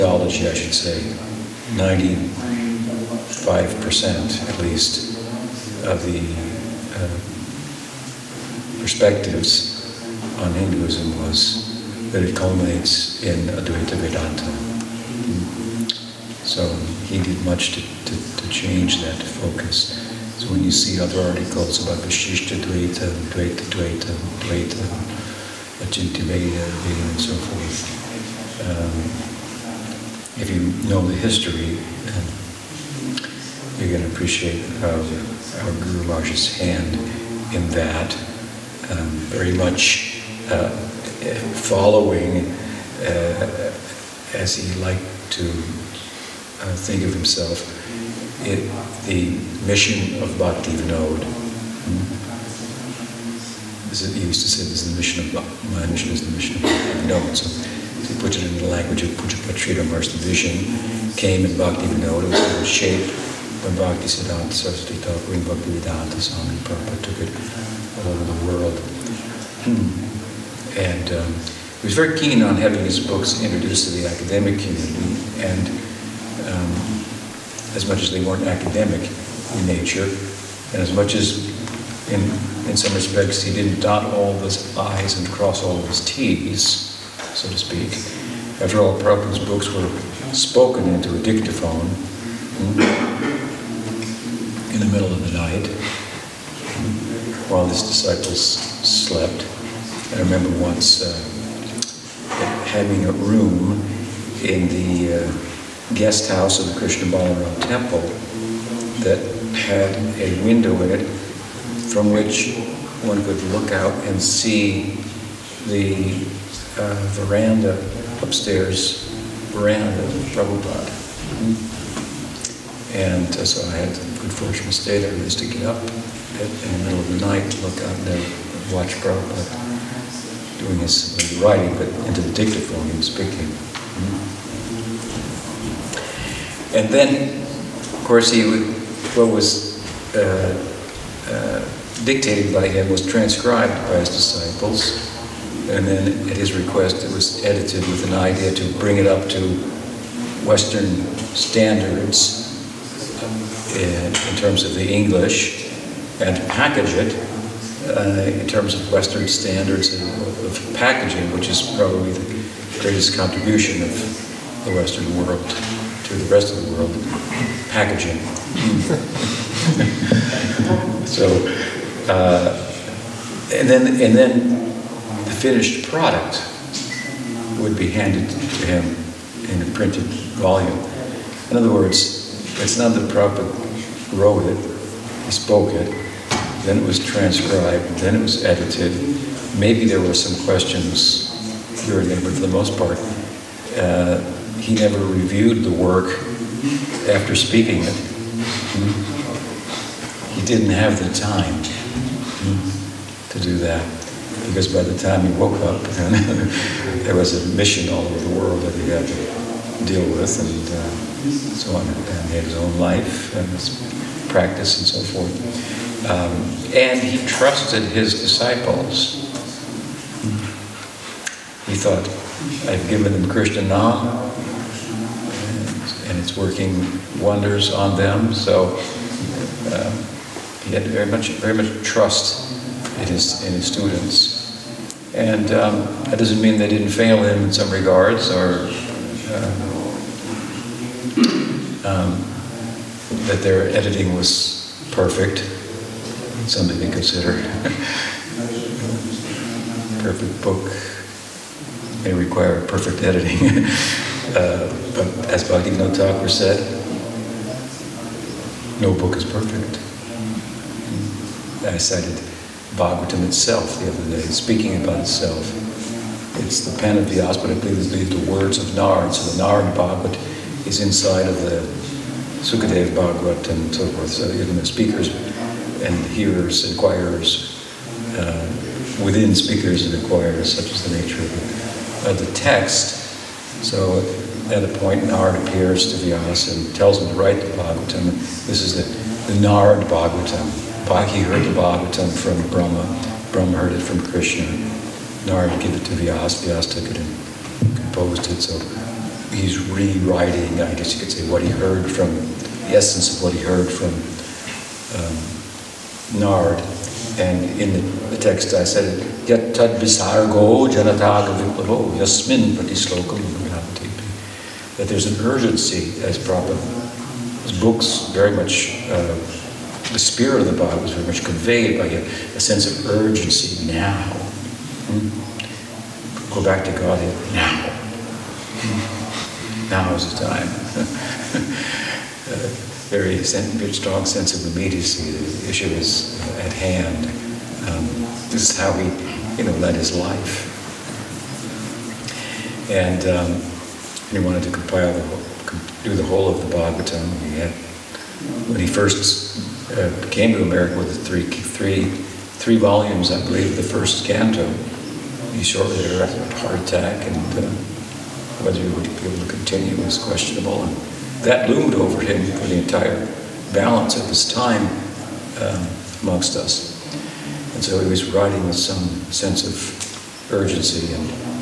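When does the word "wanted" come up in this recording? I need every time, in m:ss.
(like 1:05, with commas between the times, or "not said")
5:44.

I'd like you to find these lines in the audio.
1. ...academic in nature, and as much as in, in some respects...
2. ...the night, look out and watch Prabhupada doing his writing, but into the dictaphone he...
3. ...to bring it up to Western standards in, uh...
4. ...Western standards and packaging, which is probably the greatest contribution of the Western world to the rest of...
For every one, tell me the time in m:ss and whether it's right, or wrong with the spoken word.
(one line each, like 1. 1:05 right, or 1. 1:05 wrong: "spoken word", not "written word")
1. 1:18 right
2. 2:07 right
3. 2:28 right
4. 2:38 right.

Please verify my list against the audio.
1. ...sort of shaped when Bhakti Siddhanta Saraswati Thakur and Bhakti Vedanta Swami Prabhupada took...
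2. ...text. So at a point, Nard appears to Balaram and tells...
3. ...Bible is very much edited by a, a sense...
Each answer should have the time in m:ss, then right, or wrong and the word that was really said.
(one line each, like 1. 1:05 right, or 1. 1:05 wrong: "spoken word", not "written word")
1. 1:02 right
2. 4:42 wrong: "Vyasa", not "Balaram"
3. 5:20 wrong: "conveyed", not "edited".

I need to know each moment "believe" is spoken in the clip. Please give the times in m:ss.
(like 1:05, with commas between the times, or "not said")
4:27, 5:53.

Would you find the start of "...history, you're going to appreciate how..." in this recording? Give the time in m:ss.
0:31.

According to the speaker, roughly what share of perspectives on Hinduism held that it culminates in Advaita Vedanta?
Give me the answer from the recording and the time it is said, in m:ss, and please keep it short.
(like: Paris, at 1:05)
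95%, at 0:01.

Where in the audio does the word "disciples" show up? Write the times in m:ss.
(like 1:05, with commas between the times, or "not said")
1:37, 2:24, 3:38.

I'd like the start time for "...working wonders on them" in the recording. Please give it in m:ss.
3:46.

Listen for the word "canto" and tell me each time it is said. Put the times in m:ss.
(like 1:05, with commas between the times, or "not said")
5:54.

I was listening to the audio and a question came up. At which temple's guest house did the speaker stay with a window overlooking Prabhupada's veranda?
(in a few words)
Krishna Balaram temple.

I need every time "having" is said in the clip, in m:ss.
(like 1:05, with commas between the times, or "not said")
1:12, 1:42.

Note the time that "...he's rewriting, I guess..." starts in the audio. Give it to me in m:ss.
4:59.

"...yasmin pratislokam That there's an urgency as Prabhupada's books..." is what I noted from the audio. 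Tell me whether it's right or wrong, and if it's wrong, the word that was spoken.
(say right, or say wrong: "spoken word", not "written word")
right.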